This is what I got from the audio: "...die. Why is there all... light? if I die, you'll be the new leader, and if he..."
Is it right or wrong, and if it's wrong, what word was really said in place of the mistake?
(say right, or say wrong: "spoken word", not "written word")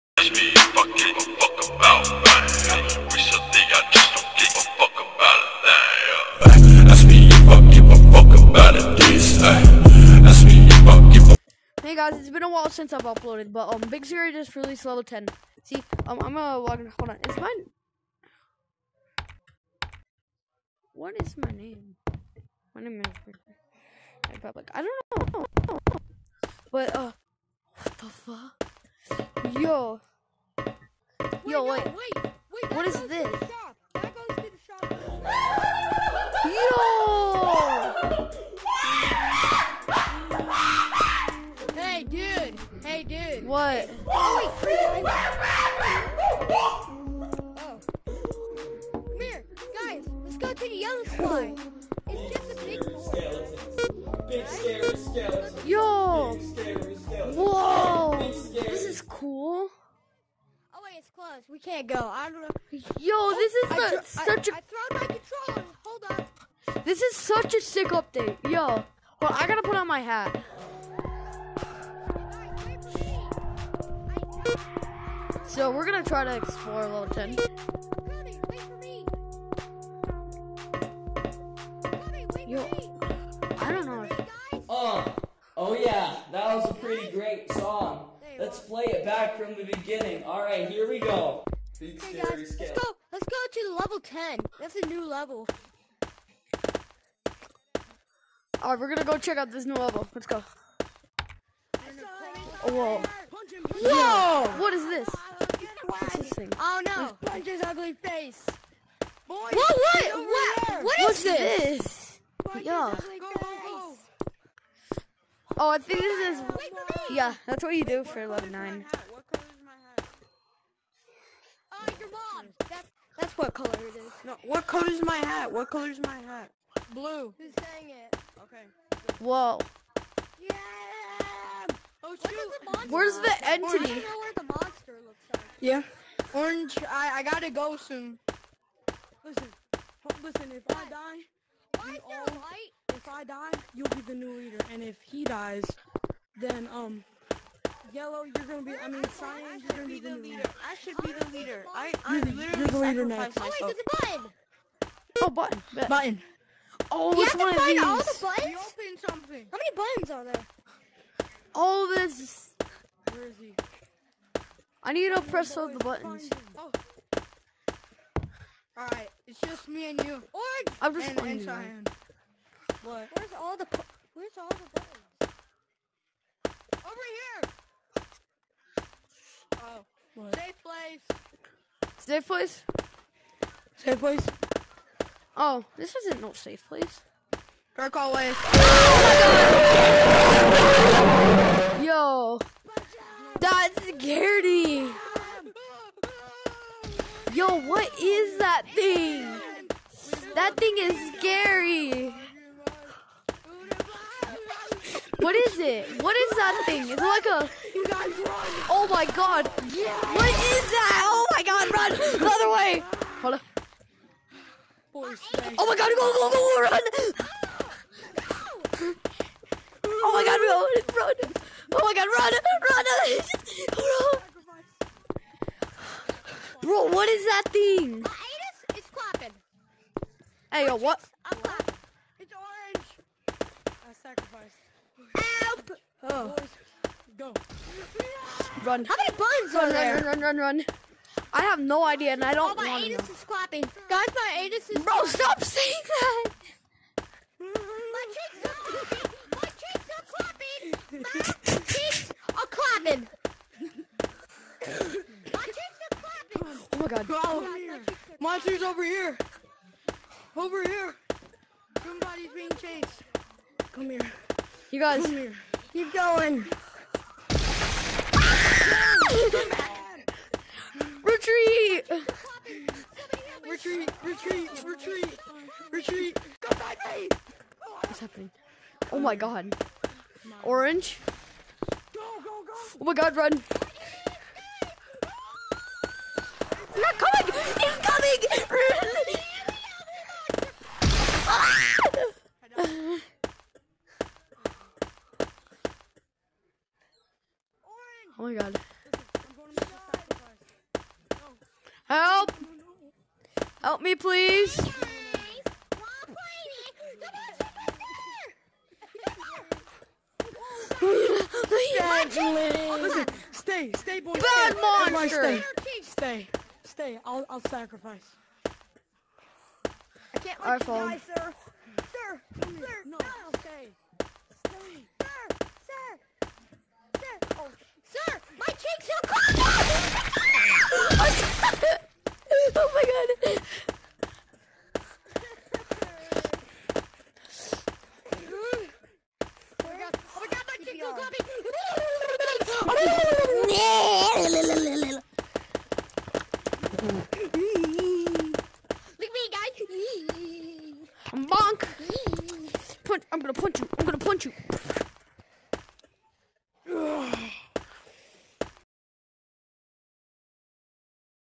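right.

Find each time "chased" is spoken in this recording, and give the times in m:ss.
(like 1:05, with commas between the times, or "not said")
4:22.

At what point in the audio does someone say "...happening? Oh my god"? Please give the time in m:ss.
4:37.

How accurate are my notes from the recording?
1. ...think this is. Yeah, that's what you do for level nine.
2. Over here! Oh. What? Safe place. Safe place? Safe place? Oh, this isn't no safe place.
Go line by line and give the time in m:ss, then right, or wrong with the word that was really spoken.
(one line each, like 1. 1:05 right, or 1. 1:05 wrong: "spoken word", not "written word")
1. 1:55 right
2. 2:56 right.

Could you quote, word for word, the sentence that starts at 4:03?
Guys, my anus is Bro, clapping.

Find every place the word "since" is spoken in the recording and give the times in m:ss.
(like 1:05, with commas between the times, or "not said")
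0:12.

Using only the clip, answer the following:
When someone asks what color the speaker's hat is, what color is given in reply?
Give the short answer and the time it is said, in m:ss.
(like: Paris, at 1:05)
Blue, at 2:06.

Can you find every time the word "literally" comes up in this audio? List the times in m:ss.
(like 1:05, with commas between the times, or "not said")
2:32.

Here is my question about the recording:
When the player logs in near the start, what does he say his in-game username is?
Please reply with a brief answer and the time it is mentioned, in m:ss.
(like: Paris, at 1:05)
Republic, at 0:22.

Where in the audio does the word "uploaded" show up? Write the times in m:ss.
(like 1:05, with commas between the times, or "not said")
0:13.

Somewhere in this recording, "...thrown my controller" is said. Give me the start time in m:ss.
1:04.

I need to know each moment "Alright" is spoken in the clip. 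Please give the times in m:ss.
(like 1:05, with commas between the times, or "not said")
1:30, 1:38.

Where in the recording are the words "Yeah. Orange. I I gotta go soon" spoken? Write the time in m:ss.
2:15.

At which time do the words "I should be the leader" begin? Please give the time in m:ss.
2:30.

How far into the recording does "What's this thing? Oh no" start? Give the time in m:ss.
1:45.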